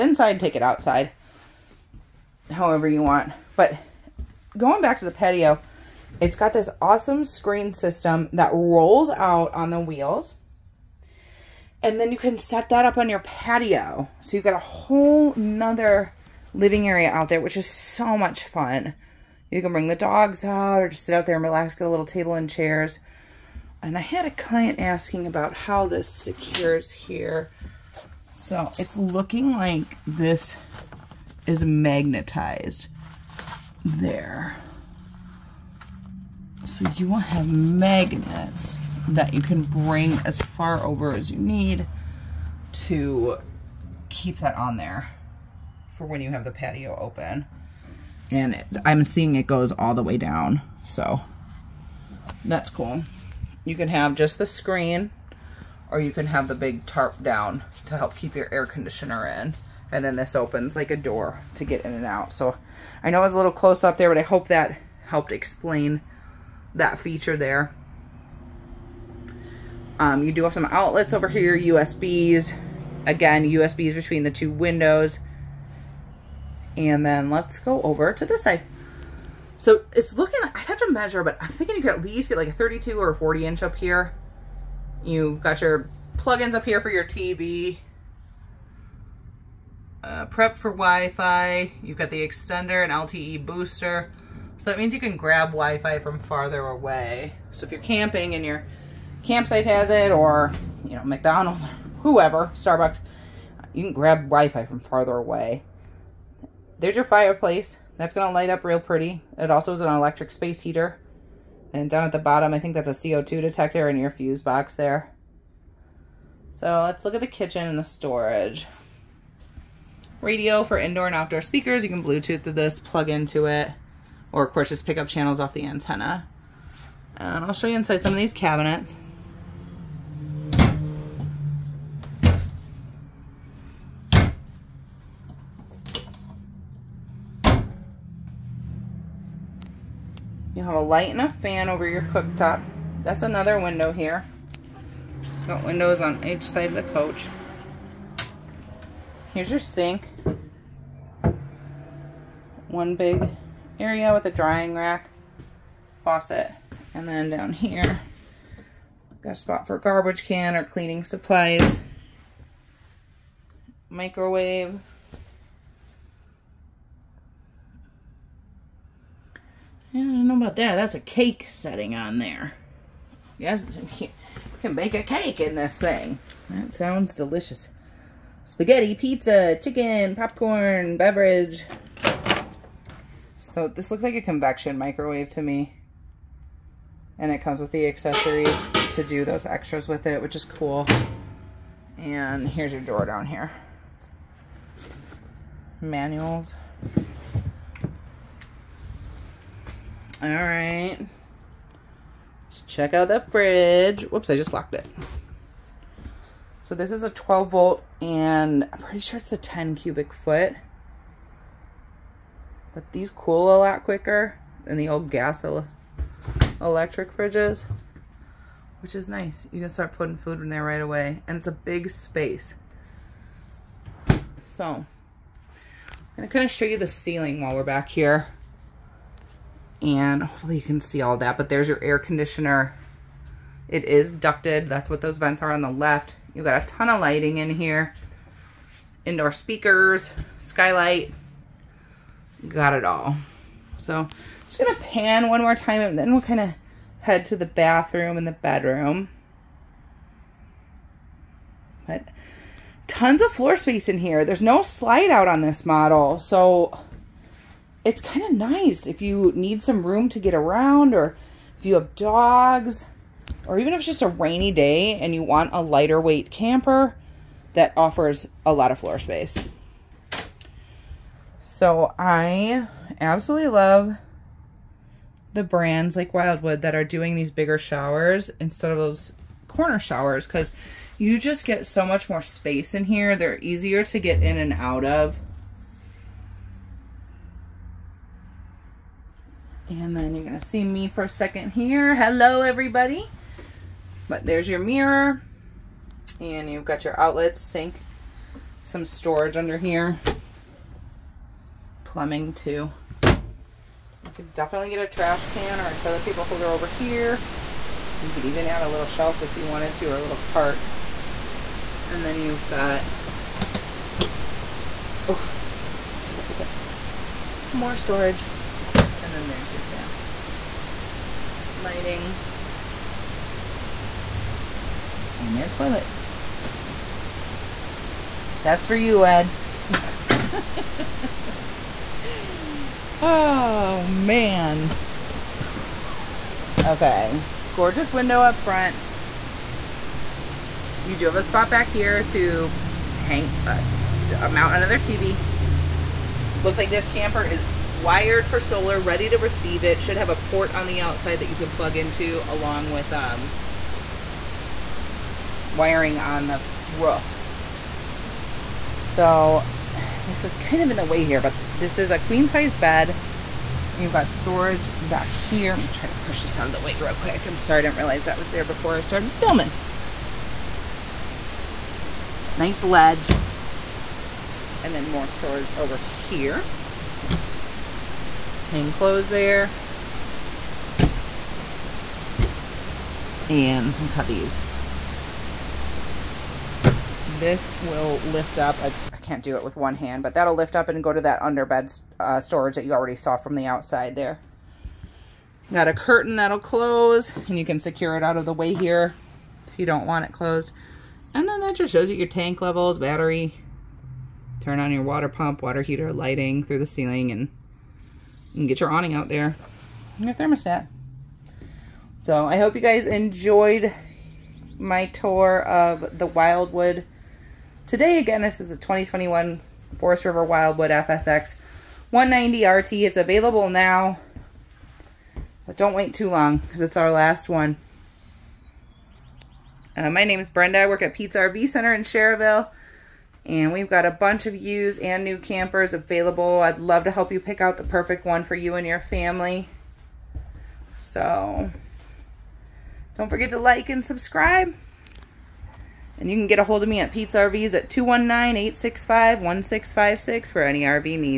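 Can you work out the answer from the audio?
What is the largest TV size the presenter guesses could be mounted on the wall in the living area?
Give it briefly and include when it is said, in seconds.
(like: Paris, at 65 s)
40 inch, at 83 s.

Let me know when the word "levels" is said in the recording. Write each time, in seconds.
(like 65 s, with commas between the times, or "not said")
402 s.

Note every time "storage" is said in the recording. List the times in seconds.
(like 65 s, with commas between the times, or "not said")
117 s, 298 s, 317 s, 364 s, 375 s, 392 s.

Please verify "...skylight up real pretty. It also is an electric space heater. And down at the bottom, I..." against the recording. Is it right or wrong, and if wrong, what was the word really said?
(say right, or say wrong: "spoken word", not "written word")
wrong: "light", not "skylight".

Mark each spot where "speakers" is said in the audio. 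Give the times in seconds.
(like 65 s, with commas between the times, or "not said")
121 s, 239 s.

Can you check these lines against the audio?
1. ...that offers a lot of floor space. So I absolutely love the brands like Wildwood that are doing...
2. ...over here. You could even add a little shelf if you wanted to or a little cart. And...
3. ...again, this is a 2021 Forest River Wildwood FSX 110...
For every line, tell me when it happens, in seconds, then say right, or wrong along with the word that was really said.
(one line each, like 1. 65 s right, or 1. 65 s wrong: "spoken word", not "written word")
1. 267 s right
2. 306 s right
3. 417 s wrong: "190", not "110".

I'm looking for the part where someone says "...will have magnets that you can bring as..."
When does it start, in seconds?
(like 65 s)
37 s.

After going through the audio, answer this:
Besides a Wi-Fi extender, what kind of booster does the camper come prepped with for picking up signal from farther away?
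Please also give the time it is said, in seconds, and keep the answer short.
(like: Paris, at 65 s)
LTE booster, at 92 s.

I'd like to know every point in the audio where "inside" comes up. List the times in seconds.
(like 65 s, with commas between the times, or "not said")
0 s, 127 s.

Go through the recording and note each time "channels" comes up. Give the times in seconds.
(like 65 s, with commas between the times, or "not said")
125 s.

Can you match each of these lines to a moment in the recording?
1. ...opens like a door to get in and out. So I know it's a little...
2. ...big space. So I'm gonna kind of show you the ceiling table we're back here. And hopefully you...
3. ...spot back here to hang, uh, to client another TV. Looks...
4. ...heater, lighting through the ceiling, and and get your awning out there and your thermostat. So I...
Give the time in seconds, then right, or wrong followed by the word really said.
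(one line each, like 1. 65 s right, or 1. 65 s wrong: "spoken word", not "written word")
1. 60 s right
2. 221 s wrong: "while", not "table"
3. 341 s wrong: "mount", not "client"
4. 405 s right.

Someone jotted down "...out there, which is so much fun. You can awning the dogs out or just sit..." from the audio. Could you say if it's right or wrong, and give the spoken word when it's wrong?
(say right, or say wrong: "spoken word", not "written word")
wrong: "bring", not "awning".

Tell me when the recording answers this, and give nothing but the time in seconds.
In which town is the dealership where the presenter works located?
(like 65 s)
431 s.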